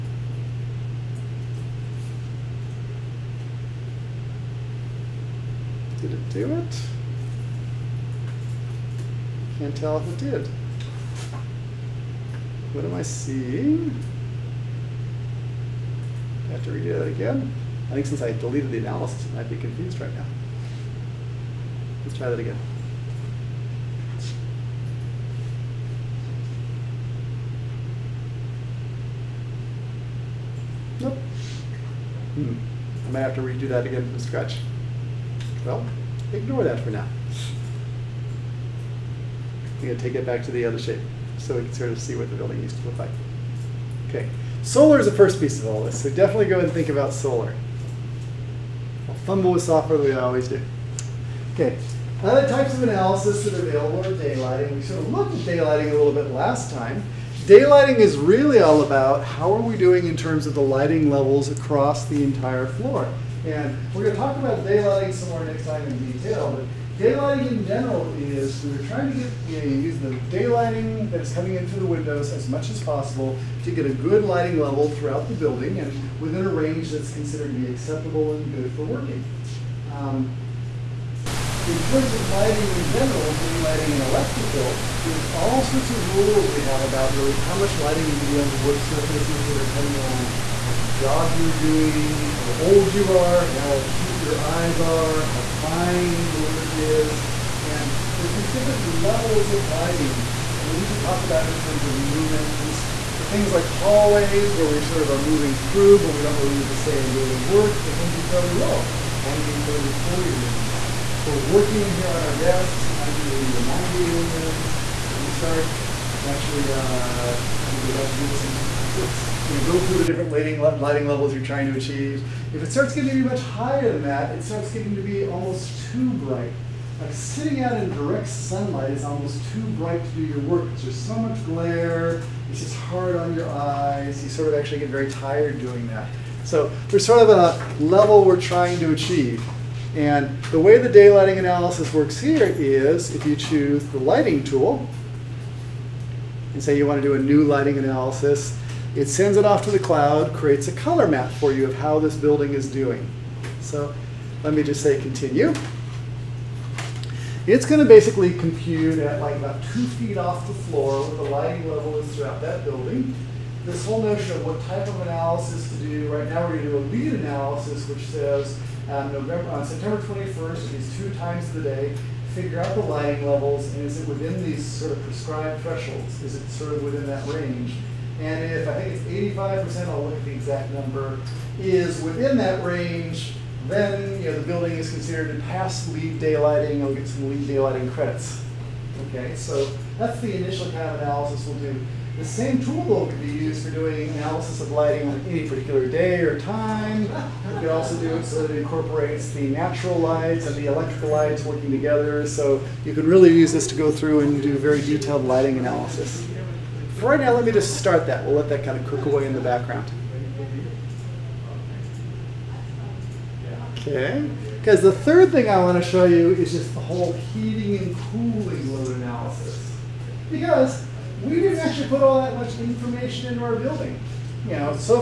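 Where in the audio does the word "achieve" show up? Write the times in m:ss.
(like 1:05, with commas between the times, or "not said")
2:01, 2:18.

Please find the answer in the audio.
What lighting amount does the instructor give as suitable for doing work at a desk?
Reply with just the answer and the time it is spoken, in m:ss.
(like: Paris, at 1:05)
80 or 90 lumens, at 1:53.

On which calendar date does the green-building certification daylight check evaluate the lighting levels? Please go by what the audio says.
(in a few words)
September 21st.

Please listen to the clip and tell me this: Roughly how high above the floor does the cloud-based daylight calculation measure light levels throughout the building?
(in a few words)
2 feet.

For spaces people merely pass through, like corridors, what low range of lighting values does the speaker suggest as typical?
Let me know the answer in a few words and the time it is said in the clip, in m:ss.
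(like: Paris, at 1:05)
20, 30, 40 lumens, at 1:49.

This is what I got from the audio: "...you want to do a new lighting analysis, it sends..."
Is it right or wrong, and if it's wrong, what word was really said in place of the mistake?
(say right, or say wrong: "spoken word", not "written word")
right.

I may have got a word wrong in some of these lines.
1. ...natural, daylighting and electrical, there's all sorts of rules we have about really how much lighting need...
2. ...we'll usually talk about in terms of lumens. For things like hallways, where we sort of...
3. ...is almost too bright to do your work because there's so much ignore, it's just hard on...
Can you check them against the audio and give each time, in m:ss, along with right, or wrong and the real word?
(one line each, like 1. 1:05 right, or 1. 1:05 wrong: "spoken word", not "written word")
1. 1:22 wrong: "general", not "natural"
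2. 1:40 right
3. 2:08 wrong: "glare", not "ignore".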